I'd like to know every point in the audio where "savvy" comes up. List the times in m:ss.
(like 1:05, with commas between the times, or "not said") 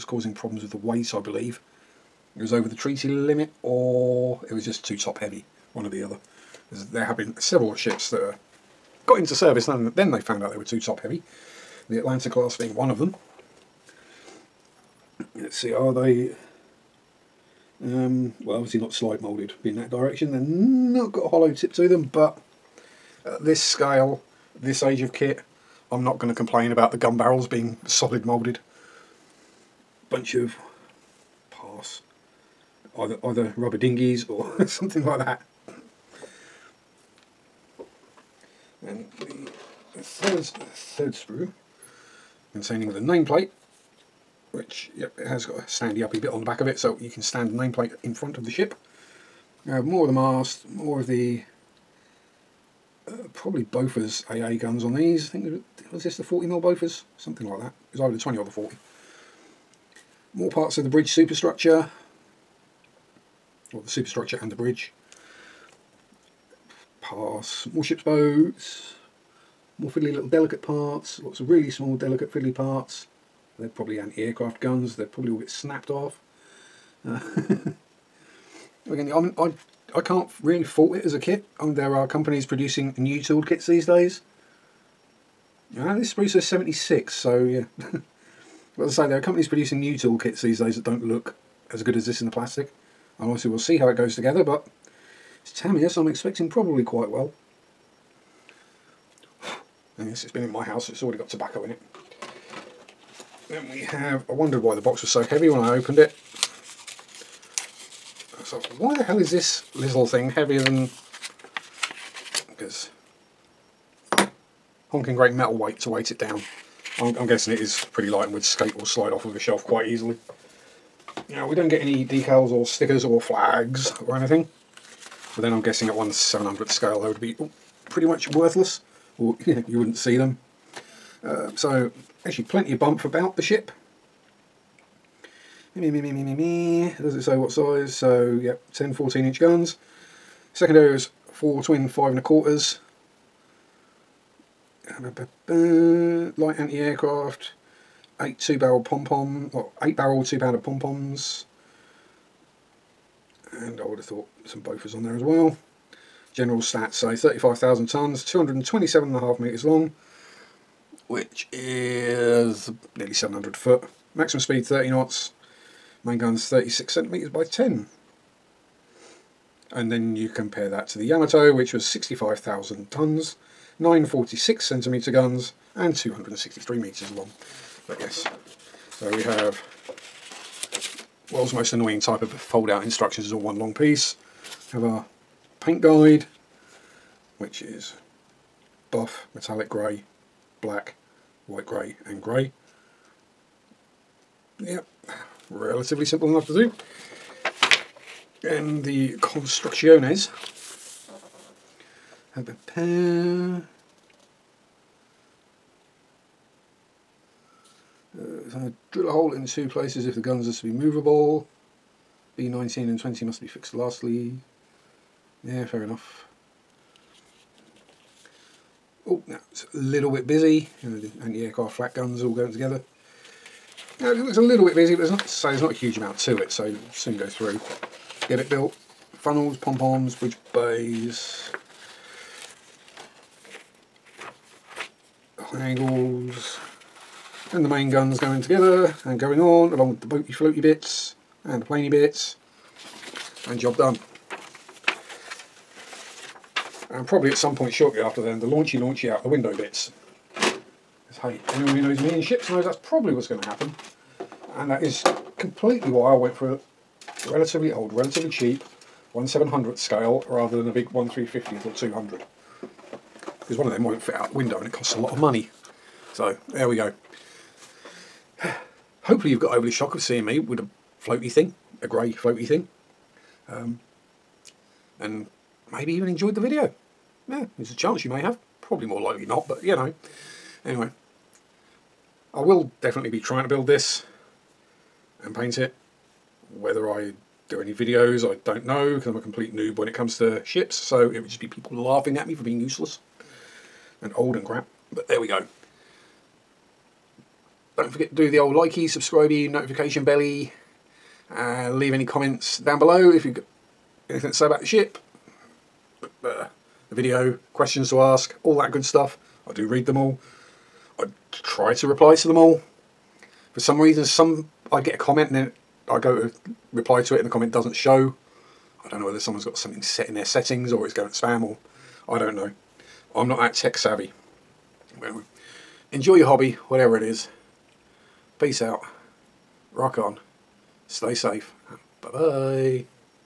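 5:23.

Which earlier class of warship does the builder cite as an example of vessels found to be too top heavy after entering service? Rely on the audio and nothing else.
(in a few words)
Atlanta class.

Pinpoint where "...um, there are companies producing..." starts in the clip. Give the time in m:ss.
1:21.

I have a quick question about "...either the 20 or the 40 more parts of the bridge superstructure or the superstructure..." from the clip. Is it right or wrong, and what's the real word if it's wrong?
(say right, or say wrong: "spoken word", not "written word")
right.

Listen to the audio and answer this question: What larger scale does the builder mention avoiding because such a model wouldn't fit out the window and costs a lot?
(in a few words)
1/350.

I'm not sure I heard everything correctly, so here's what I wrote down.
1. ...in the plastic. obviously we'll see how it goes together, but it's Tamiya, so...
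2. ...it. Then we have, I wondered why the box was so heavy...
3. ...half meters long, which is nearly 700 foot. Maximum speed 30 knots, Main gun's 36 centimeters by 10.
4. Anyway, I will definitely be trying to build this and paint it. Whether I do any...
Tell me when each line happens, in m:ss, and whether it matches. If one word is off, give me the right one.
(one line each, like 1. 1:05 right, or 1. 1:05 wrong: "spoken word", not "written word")
1. 1:32 right
2. 1:41 right
3. 2:39 right
4. 4:40 right.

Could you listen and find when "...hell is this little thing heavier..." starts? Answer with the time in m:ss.
1:49.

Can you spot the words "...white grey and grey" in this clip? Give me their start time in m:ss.
3:11.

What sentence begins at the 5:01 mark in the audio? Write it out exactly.
Uh, leave any comments down below if you've got anything to say about the ship.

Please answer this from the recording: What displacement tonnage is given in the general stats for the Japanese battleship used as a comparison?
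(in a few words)
65,000 tons.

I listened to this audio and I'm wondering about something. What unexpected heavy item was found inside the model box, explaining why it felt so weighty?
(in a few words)
metal weight.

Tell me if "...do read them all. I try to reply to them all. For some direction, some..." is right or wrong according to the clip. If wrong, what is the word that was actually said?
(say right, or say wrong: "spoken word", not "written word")
wrong: "reason", not "direction".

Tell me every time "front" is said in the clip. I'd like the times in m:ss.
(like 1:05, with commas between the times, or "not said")
0:48.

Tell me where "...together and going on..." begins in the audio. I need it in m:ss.
3:58.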